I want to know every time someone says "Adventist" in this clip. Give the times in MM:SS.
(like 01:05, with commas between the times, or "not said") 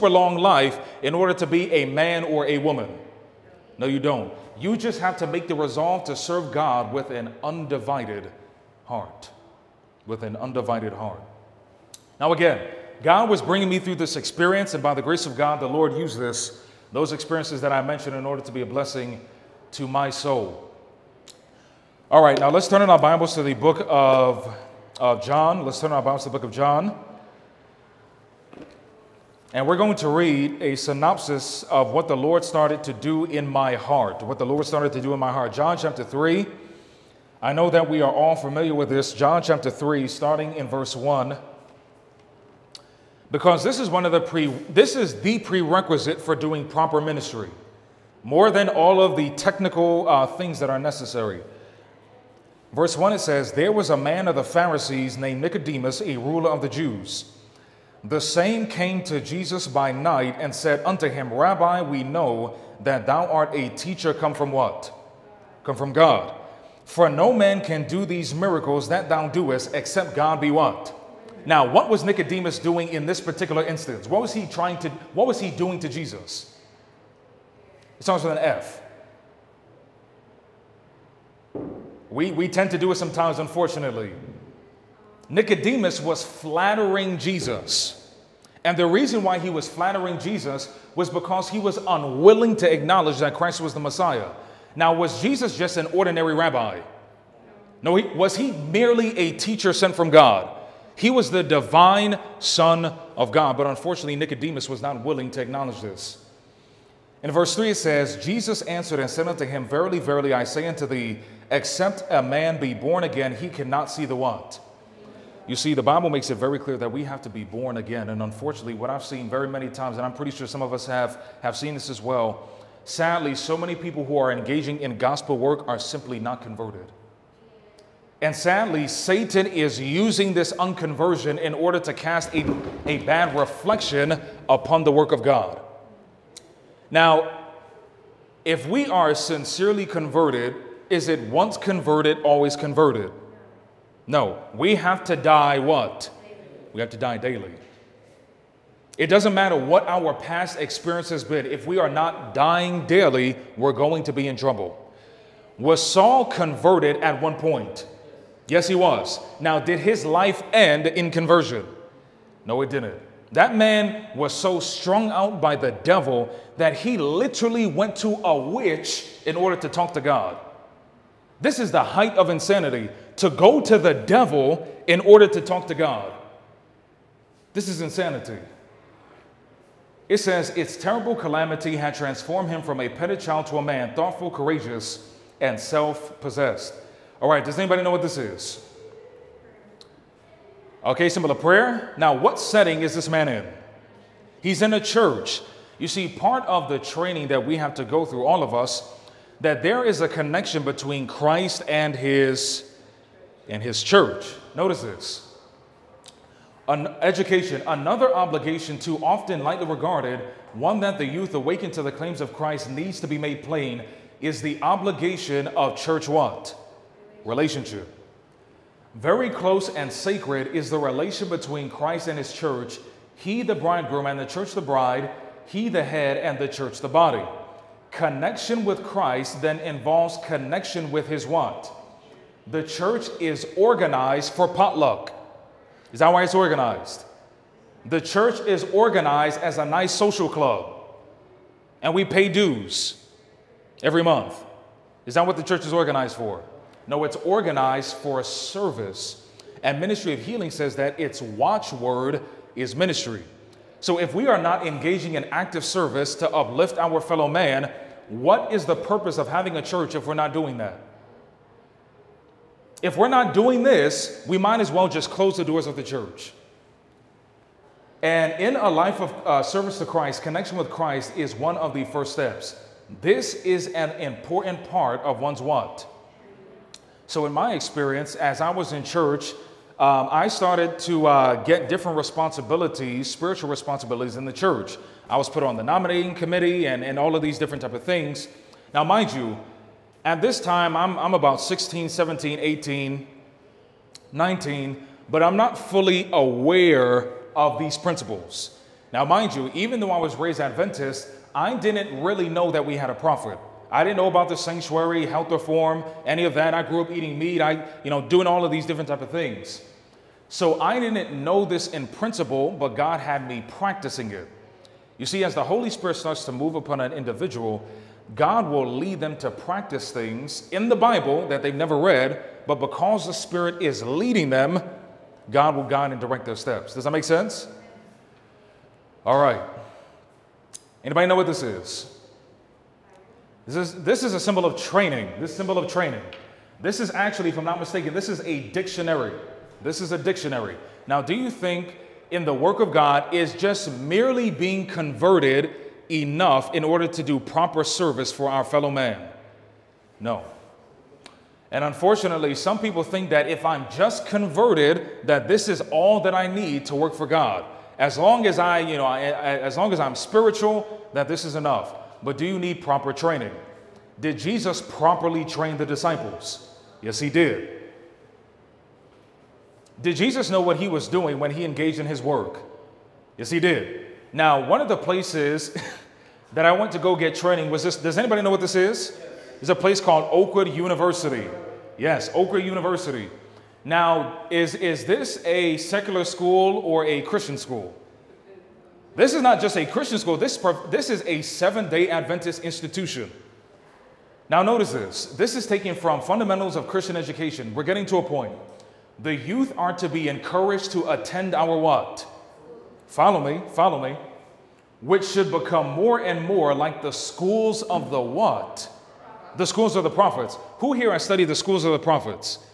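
05:00, 06:31.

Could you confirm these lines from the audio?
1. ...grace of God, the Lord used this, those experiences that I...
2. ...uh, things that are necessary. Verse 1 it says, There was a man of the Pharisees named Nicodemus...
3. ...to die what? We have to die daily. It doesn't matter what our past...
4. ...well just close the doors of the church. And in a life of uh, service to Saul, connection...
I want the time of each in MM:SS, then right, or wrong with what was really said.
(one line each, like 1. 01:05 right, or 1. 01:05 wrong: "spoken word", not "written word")
1. 00:15 right
2. 00:50 right
3. 02:25 right
4. 04:24 wrong: "Christ", not "Saul".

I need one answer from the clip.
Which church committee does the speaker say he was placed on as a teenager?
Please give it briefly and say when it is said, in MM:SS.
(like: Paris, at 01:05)
Nominating committee, at 04:45.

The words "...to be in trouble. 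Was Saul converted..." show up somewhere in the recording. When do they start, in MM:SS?
02:34.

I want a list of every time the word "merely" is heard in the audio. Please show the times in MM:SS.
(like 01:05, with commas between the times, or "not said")
01:38, 05:43.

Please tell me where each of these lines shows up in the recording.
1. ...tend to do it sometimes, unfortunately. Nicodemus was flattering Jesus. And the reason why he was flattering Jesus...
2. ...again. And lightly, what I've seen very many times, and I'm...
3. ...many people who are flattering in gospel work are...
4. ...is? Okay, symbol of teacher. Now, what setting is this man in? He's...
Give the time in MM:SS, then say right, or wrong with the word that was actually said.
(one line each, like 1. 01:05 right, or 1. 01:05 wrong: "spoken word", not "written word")
1. 01:22 right
2. 01:57 wrong: "unfortunately", not "lightly"
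3. 02:03 wrong: "engaging", not "flattering"
4. 03:08 wrong: "prayer", not "teacher".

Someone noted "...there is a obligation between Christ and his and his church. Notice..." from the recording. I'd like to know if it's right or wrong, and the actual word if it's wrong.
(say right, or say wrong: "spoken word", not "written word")
wrong: "connection", not "obligation".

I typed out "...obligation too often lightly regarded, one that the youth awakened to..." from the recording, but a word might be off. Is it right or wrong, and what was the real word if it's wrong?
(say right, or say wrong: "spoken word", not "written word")
right.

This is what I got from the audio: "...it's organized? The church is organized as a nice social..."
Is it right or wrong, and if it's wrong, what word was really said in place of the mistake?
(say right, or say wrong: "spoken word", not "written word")
right.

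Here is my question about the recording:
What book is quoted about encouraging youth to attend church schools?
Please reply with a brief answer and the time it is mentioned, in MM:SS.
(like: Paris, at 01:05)
Fundamentals of Christian Education, at 06:36.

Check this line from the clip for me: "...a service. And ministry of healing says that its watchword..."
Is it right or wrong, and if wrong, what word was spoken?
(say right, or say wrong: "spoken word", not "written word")
right.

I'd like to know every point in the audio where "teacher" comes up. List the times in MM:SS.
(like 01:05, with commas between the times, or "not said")
01:03, 01:39.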